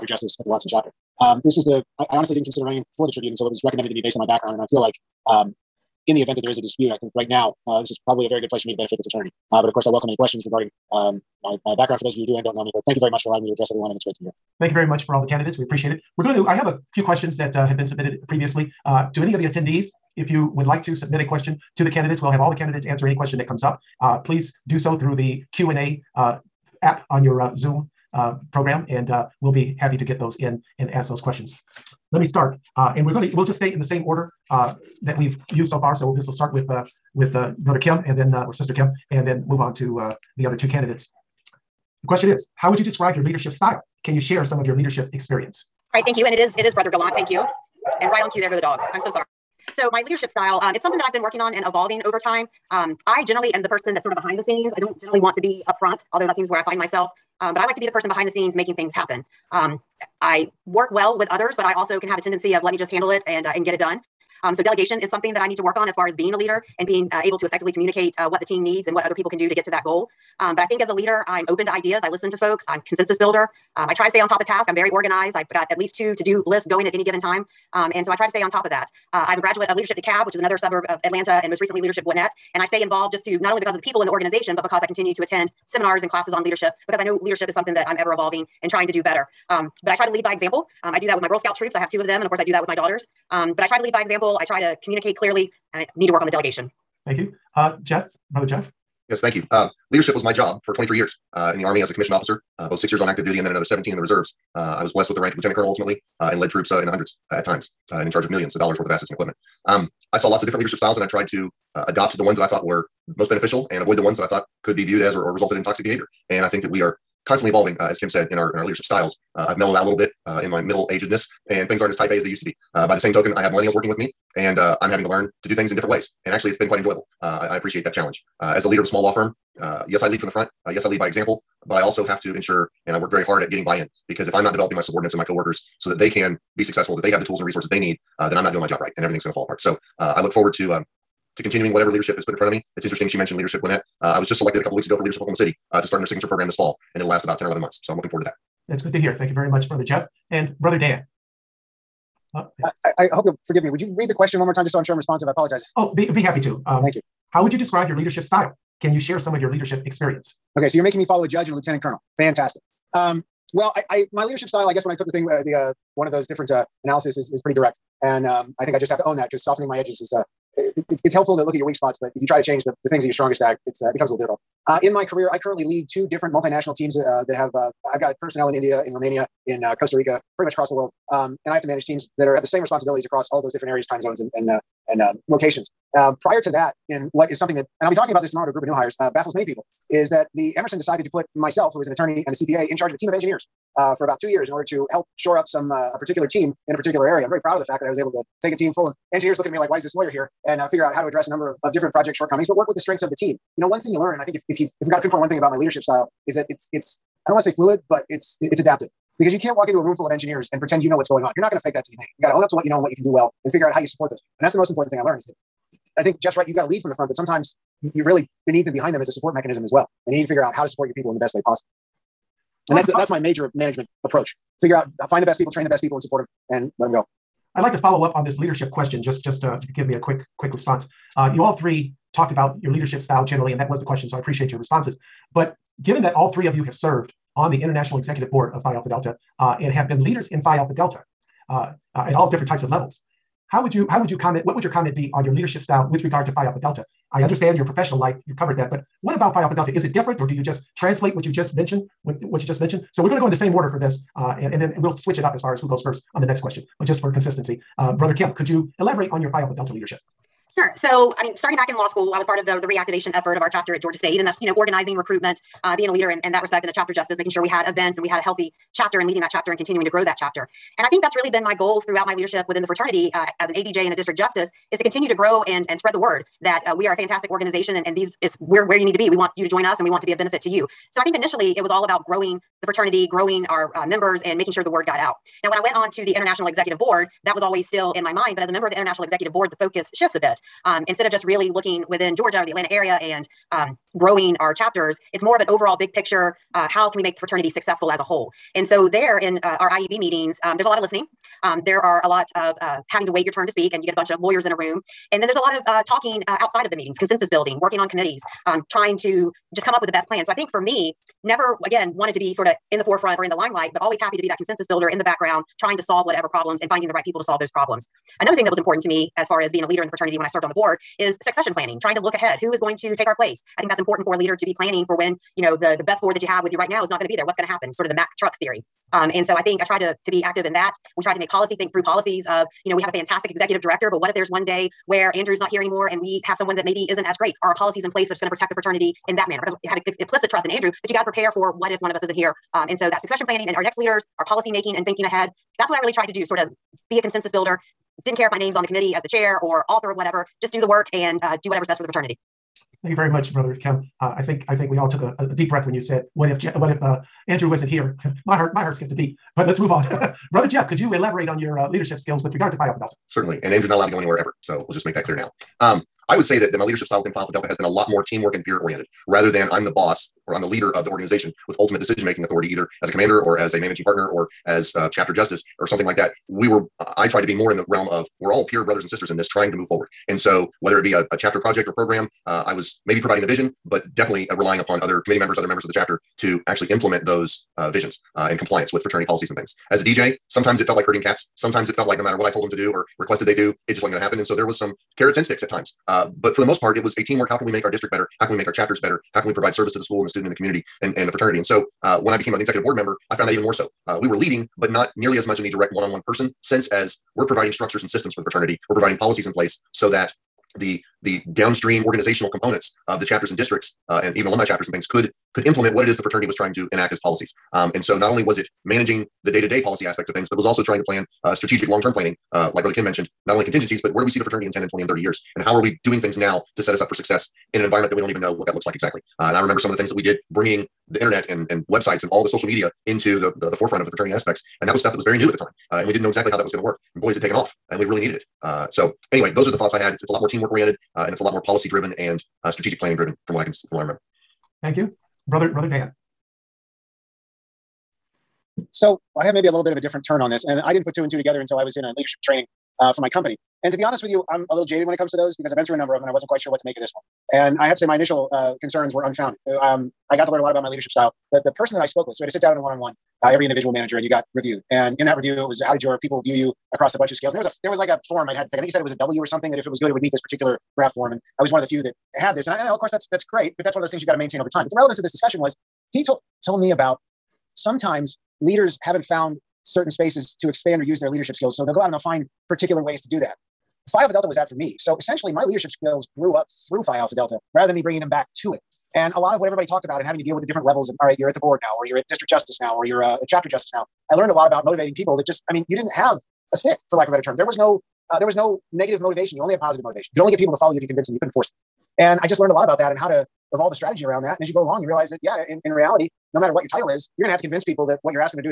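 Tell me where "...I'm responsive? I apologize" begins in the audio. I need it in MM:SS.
02:34.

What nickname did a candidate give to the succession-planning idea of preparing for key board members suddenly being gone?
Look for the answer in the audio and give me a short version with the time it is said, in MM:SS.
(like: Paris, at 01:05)
Mack truck theory, at 05:27.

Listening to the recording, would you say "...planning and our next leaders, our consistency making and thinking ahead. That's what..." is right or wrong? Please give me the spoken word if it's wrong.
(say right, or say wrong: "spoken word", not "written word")
wrong: "policy", not "consistency".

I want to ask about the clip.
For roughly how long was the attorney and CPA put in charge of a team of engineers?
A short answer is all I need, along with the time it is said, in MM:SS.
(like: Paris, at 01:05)
2 years, at 03:14.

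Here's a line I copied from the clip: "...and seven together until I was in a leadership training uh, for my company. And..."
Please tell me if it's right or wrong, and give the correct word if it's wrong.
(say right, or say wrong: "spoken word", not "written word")
wrong: "two", not "seven".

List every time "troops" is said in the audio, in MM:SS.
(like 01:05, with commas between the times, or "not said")
01:31, 01:46.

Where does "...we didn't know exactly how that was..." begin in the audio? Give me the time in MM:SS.
07:15.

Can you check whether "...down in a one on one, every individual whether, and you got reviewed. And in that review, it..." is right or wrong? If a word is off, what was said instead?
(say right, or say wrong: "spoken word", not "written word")
wrong: "manager", not "whether".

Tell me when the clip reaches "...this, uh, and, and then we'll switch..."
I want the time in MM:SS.
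04:13.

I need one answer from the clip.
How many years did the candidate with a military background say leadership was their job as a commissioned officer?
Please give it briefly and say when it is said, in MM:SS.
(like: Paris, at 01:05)
23, at 01:40.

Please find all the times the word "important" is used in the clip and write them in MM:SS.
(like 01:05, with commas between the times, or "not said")
03:34, 05:18, 05:23.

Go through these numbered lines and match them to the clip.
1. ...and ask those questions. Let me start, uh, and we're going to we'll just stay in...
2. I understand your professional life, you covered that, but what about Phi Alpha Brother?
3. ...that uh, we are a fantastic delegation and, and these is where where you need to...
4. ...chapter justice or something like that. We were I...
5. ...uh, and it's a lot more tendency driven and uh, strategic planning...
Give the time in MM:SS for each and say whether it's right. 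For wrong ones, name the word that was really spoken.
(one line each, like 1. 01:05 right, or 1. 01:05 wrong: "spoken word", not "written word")
1. 00:30 right
2. 04:07 wrong: "Delta", not "Brother"
3. 04:36 wrong: "organization", not "delegation"
4. 06:14 right
5. 07:20 wrong: "policy", not "tendency".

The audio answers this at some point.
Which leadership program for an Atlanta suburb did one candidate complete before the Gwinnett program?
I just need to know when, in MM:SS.
01:19.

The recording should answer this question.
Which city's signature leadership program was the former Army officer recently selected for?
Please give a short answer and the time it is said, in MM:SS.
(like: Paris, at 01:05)
Oklahoma City, at 02:25.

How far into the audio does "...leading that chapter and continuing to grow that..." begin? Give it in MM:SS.
04:29.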